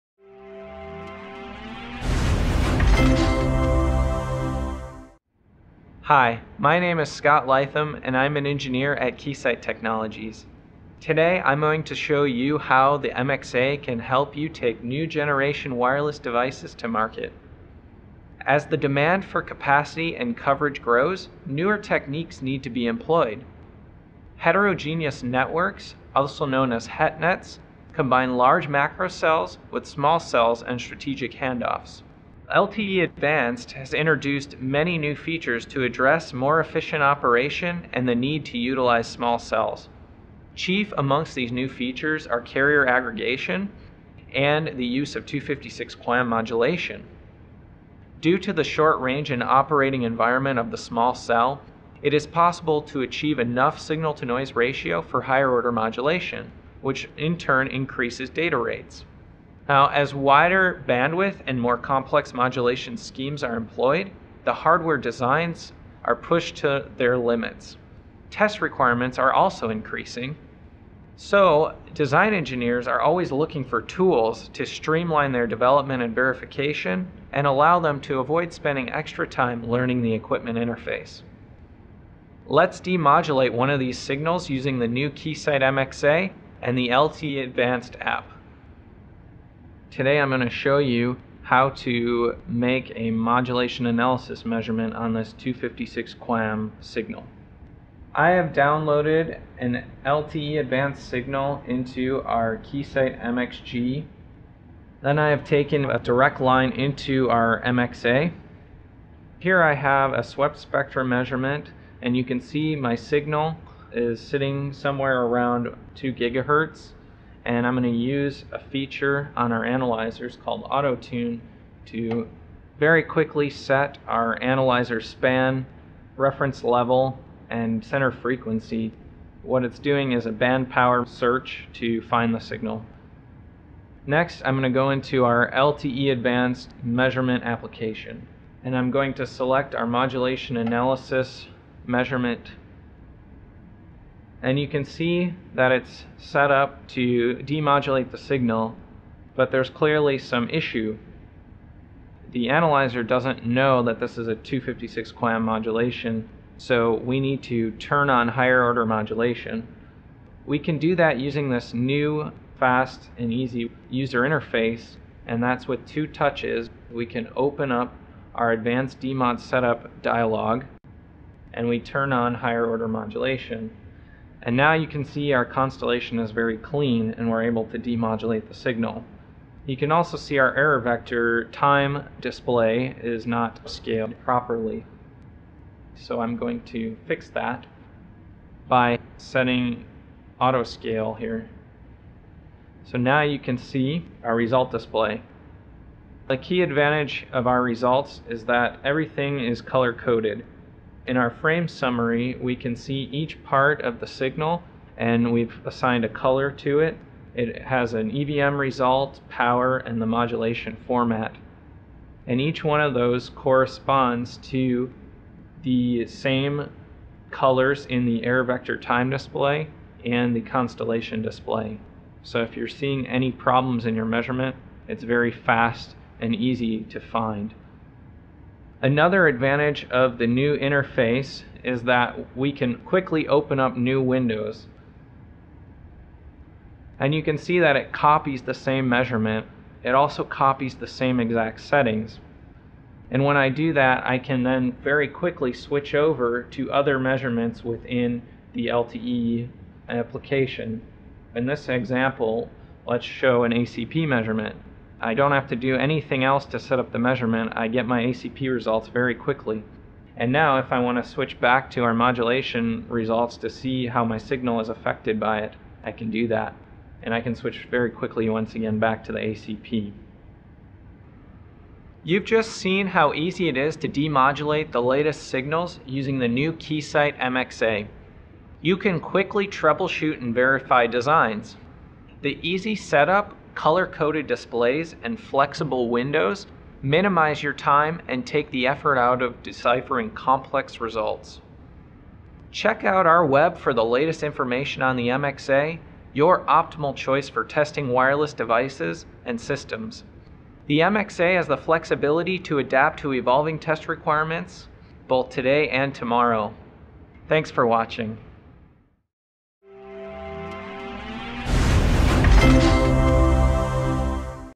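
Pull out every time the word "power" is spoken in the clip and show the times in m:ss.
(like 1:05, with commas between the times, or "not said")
2:10, 3:29.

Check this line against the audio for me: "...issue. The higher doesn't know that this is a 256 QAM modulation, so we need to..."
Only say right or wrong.
wrong.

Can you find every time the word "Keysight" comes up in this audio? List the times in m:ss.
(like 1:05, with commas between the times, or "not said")
0:09, 1:25, 1:42, 4:36.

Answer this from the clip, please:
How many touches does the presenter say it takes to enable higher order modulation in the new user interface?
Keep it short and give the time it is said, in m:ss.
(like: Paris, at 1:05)
2, at 2:45.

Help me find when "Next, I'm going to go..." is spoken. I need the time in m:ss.
2:14.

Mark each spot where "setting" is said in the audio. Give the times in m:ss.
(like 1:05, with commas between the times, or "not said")
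3:09, 4:01.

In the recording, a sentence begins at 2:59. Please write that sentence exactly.
You can also see our error vector time display is not scaled properly.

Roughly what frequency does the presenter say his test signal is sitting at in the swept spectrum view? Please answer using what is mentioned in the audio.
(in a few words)
2 gigahertz.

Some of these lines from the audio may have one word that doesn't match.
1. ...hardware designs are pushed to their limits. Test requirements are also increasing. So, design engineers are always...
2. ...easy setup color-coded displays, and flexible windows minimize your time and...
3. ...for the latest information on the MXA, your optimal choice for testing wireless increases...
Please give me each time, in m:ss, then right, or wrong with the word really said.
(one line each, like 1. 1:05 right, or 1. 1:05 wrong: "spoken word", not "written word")
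1. 1:04 right
2. 4:42 right
3. 4:53 wrong: "devices", not "increases".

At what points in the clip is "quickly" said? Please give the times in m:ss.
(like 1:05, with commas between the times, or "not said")
2:03, 3:52, 4:05, 4:19, 4:27, 4:38.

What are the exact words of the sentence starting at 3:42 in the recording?
So if you're seeing any problems in your measurement, it's very fast and easy to find.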